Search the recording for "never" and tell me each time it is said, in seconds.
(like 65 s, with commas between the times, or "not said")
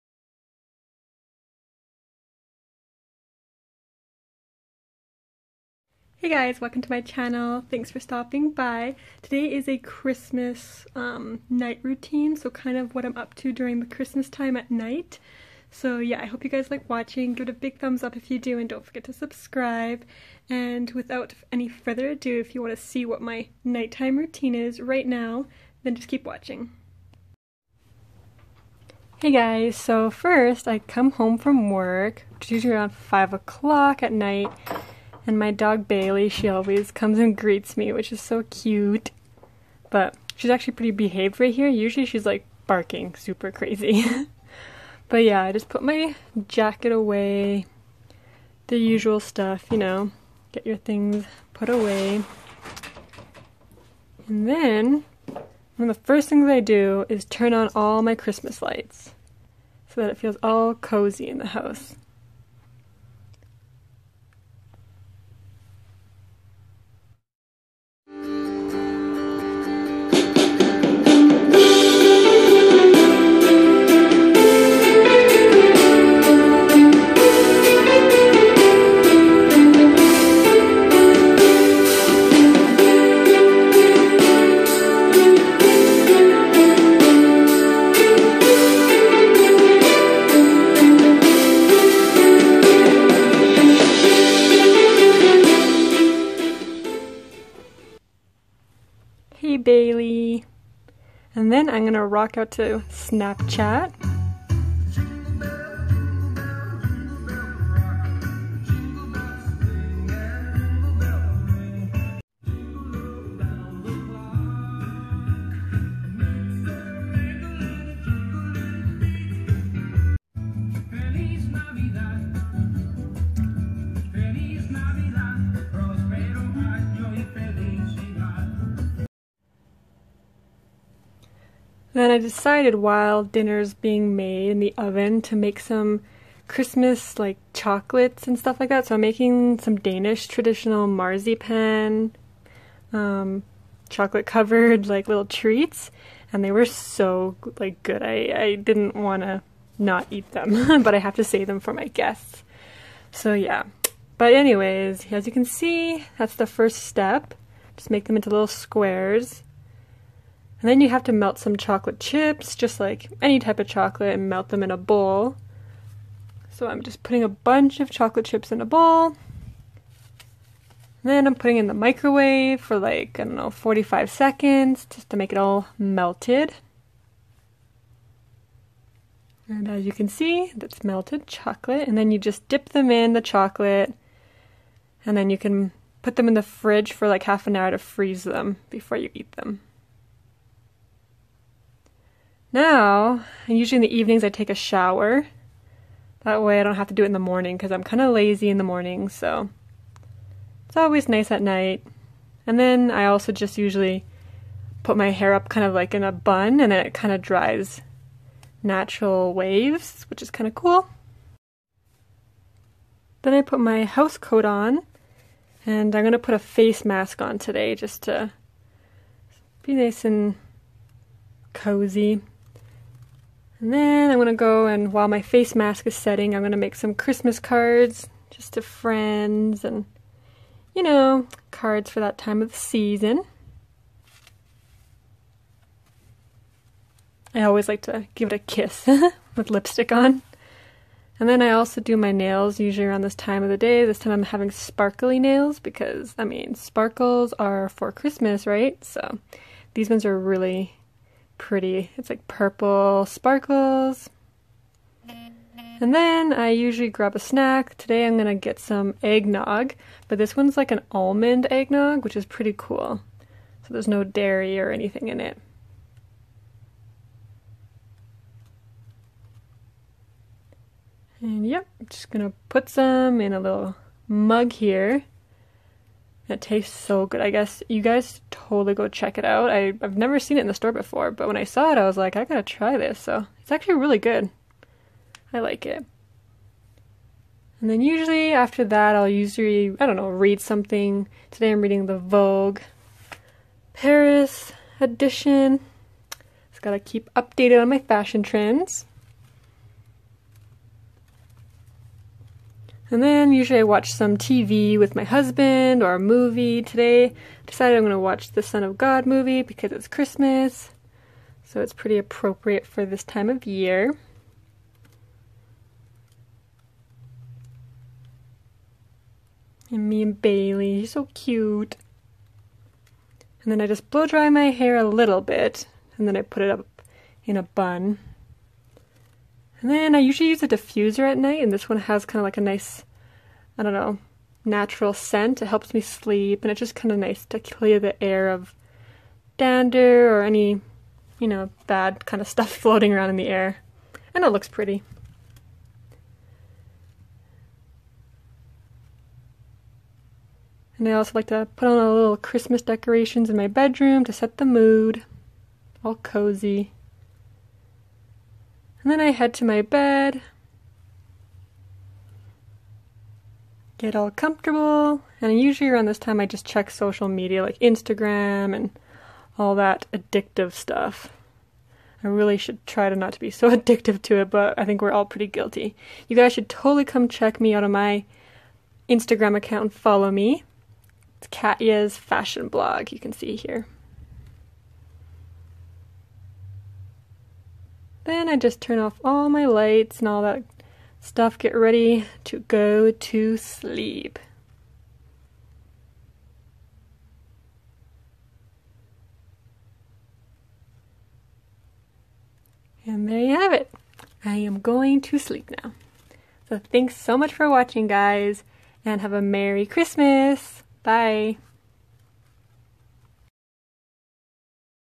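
279 s.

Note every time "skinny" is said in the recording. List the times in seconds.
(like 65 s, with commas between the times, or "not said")
not said.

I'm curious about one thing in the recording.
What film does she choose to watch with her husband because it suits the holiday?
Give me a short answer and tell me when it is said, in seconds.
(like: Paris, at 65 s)
Son of God, at 308 s.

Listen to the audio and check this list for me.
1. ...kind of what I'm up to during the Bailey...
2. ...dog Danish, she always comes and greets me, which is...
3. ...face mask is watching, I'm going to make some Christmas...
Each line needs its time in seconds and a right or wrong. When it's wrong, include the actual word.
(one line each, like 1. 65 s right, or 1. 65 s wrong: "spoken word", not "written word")
1. 12 s wrong: "Christmas", not "Bailey"
2. 35 s wrong: "Bailey", not "Danish"
3. 225 s wrong: "setting", not "watching".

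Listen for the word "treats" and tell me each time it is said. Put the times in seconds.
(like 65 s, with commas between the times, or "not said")
145 s.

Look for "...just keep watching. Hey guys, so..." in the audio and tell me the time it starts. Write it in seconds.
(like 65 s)
25 s.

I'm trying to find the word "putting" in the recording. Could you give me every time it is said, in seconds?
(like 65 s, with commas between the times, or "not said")
167 s, 171 s.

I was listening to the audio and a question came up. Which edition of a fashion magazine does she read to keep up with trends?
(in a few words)
Vogue Paris.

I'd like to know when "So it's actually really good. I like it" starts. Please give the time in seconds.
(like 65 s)
282 s.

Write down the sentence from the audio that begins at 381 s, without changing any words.
It's Katja's fashion blog, you can see here.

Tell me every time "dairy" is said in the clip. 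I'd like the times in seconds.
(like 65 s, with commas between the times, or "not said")
264 s.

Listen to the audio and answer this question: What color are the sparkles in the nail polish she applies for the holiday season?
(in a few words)
Purple.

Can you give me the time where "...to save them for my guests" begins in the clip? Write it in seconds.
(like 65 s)
151 s.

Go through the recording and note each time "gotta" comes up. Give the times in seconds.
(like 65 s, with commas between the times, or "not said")
282 s, 296 s.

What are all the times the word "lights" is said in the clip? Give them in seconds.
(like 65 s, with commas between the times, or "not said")
58 s, 389 s.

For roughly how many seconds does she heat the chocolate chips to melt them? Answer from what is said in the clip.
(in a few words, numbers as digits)
45.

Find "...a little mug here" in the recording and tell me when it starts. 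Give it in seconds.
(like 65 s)
273 s.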